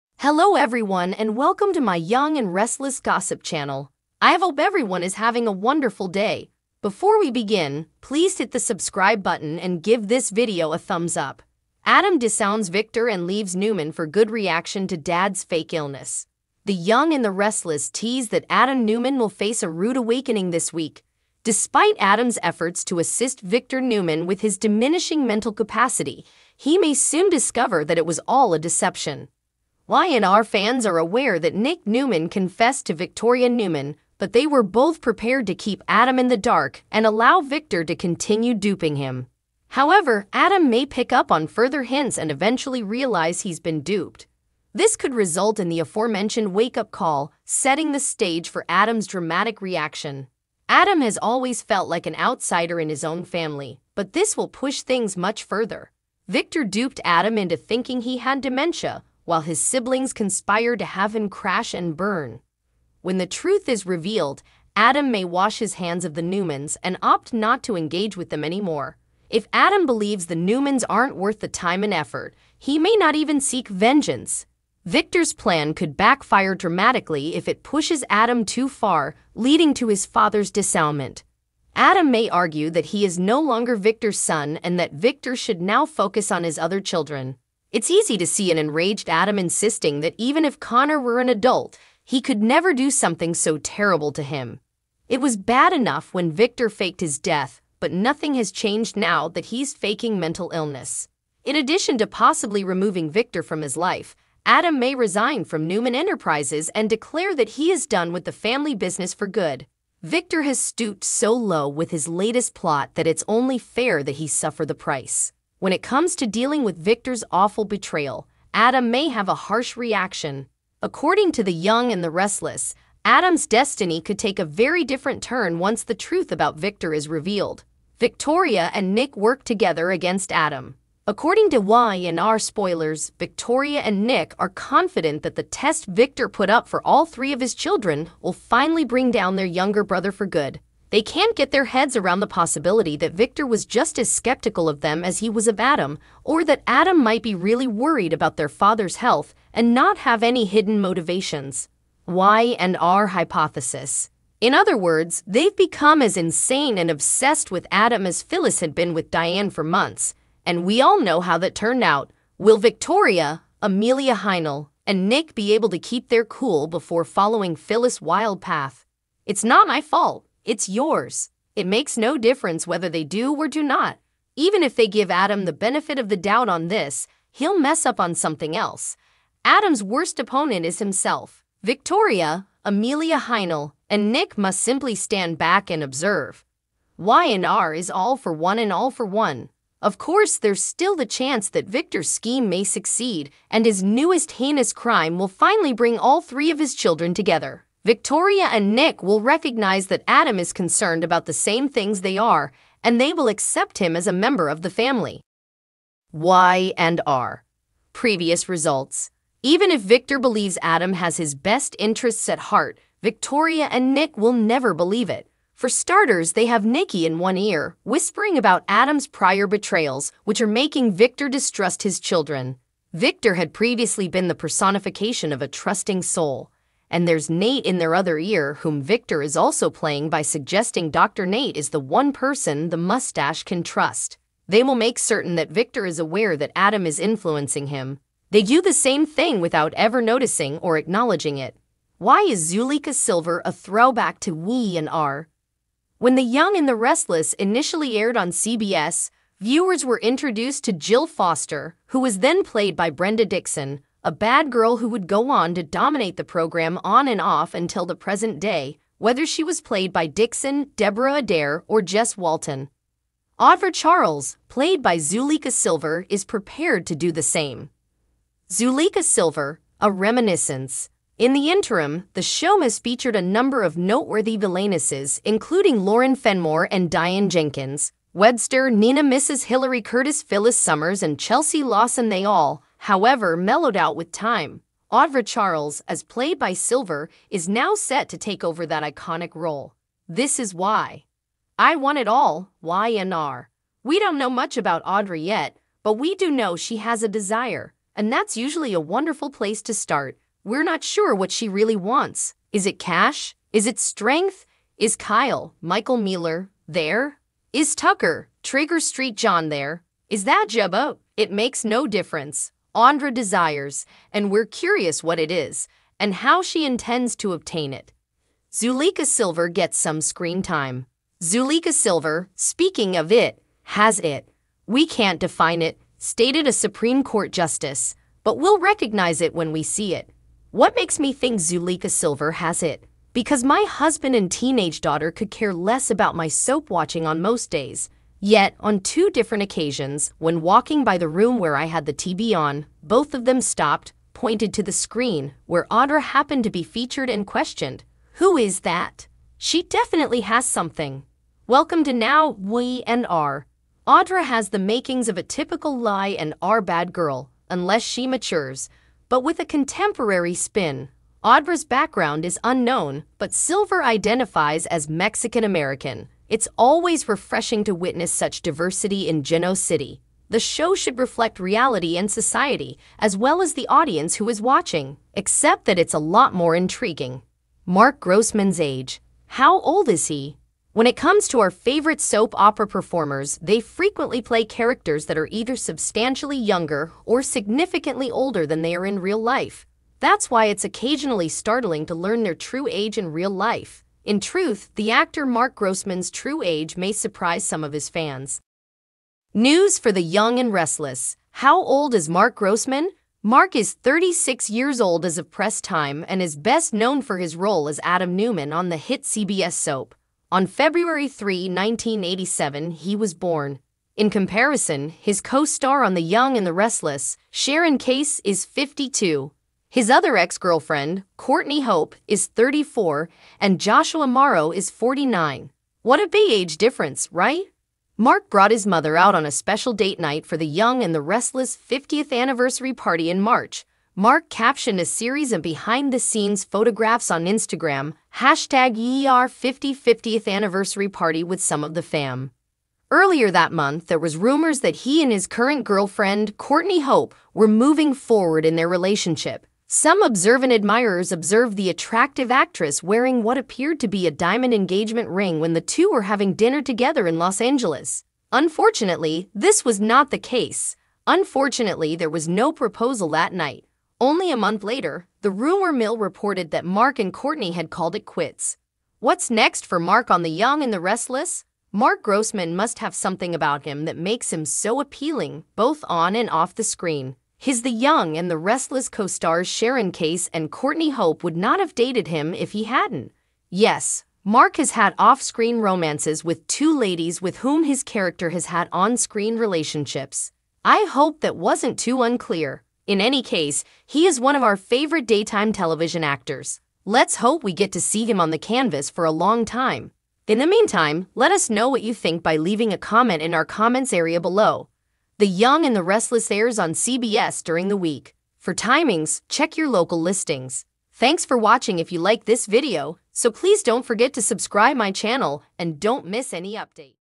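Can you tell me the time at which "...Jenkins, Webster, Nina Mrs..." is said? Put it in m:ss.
4:37.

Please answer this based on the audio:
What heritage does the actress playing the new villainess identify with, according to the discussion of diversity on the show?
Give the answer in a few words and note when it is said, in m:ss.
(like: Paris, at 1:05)
Mexican American, at 6:04.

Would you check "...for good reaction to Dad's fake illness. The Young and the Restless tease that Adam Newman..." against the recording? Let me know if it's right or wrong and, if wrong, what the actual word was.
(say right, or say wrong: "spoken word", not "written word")
right.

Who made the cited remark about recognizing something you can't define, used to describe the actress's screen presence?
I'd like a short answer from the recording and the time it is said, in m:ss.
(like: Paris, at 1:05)
A Supreme Court justice, at 5:26.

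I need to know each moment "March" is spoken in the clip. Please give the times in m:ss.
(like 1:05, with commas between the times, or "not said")
7:13.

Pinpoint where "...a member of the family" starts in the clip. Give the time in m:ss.
3:24.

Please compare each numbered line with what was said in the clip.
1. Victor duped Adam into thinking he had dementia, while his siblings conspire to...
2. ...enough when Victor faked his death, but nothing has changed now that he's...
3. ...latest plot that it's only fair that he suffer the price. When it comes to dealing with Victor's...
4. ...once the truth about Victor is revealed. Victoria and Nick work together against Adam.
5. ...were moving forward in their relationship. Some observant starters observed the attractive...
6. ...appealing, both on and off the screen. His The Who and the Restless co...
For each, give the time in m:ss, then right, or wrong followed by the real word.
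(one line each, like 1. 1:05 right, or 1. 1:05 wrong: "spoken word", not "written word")
1. 0:56 right
2. 1:35 right
3. 1:52 right
4. 2:05 right
5. 7:27 wrong: "admirers", not "starters"
6. 7:54 wrong: "Young", not "Who".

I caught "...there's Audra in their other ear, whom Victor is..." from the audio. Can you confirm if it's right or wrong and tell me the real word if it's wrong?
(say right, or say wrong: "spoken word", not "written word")
wrong: "Nate", not "Audra".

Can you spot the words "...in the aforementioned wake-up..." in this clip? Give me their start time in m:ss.
0:45.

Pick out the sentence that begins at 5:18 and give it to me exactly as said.
Zuleyka Silver gets some screen time.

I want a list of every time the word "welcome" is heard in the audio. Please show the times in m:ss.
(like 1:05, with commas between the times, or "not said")
0:01, 5:51.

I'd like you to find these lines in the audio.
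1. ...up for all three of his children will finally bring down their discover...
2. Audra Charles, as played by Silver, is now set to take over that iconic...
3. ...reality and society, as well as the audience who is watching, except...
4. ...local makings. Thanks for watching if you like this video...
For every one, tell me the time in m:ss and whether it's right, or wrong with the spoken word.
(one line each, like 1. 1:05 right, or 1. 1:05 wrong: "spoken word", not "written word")
1. 2:16 wrong: "younger", not "discover"
2. 4:44 right
3. 6:11 right
4. 8:29 wrong: "listings", not "makings".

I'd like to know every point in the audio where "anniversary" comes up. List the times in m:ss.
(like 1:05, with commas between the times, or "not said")
7:12, 7:20.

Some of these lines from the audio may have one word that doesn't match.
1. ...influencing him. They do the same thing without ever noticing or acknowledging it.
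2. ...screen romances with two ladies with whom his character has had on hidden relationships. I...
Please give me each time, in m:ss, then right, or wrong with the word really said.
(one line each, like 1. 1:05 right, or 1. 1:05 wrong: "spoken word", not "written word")
1. 3:56 right
2. 8:05 wrong: "screen", not "hidden".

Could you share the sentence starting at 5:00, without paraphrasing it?
We're not sure what she really wants.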